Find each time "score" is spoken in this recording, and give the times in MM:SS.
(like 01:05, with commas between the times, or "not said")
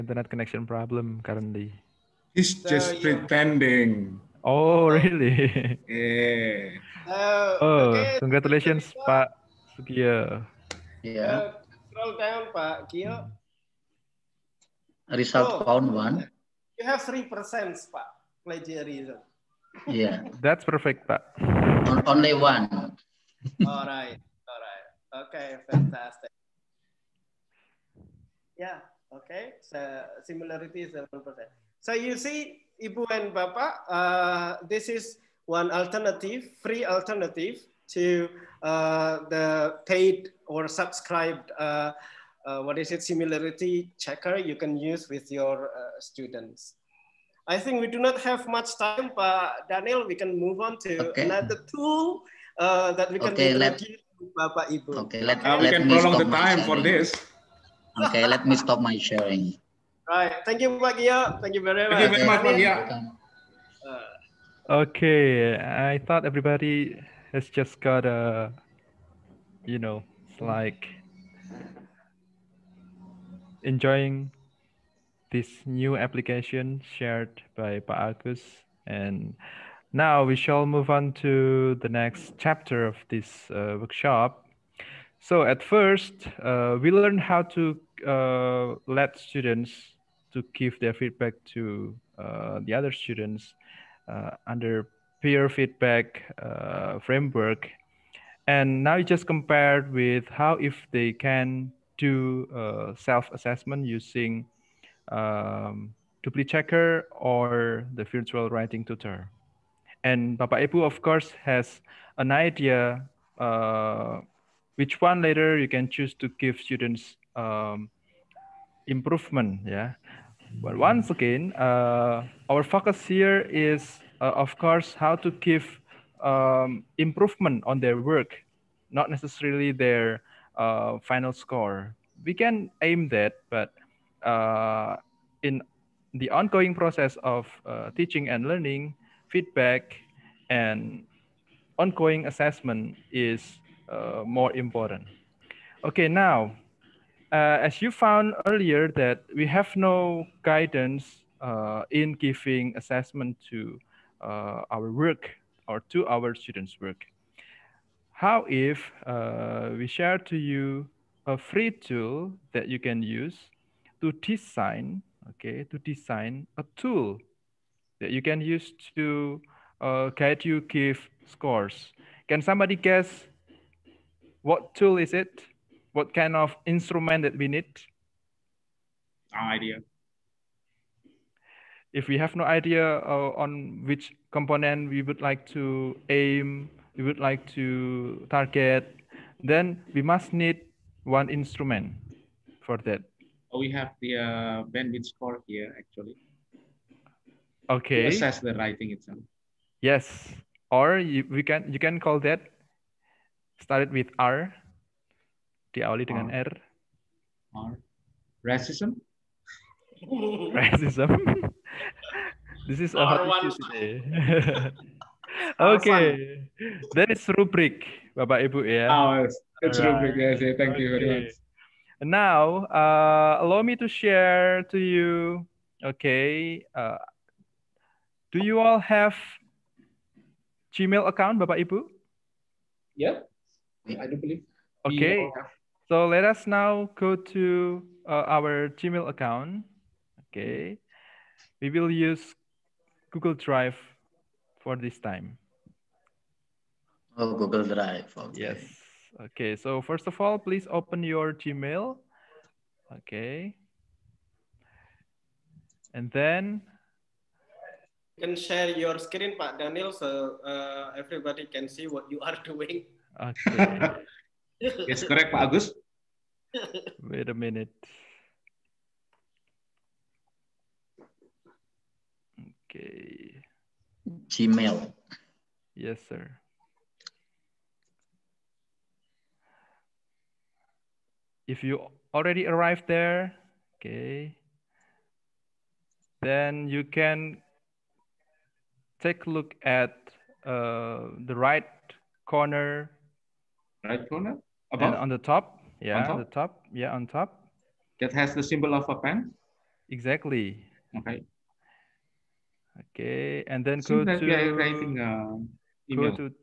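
02:11, 02:51, 03:15.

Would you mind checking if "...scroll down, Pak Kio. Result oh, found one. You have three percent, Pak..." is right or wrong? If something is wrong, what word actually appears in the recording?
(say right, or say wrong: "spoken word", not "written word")
right.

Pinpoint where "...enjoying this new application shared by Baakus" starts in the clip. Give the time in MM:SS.
01:13.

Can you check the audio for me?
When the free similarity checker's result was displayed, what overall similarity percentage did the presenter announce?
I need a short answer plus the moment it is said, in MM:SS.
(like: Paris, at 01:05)
7%, at 00:30.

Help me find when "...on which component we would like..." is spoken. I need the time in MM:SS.
03:03.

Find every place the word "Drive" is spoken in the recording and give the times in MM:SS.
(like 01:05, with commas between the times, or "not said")
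04:03, 04:07.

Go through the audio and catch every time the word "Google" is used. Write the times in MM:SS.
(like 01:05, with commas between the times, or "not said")
04:03, 04:07.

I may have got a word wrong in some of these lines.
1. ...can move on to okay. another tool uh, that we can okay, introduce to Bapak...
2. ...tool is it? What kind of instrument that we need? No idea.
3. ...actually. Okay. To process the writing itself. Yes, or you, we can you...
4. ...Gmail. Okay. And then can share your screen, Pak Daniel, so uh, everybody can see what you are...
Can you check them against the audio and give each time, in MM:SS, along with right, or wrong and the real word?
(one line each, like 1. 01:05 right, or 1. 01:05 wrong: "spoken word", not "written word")
1. 00:50 right
2. 02:54 right
3. 03:15 wrong: "assess", not "process"
4. 04:11 right.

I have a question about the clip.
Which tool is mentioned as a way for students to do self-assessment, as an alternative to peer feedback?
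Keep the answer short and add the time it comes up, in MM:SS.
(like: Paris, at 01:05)
virtual writing tutor, at 01:48.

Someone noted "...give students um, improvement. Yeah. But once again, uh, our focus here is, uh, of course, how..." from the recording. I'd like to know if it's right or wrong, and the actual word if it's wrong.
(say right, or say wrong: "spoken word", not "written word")
right.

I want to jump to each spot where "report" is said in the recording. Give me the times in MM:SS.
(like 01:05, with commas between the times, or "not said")
not said.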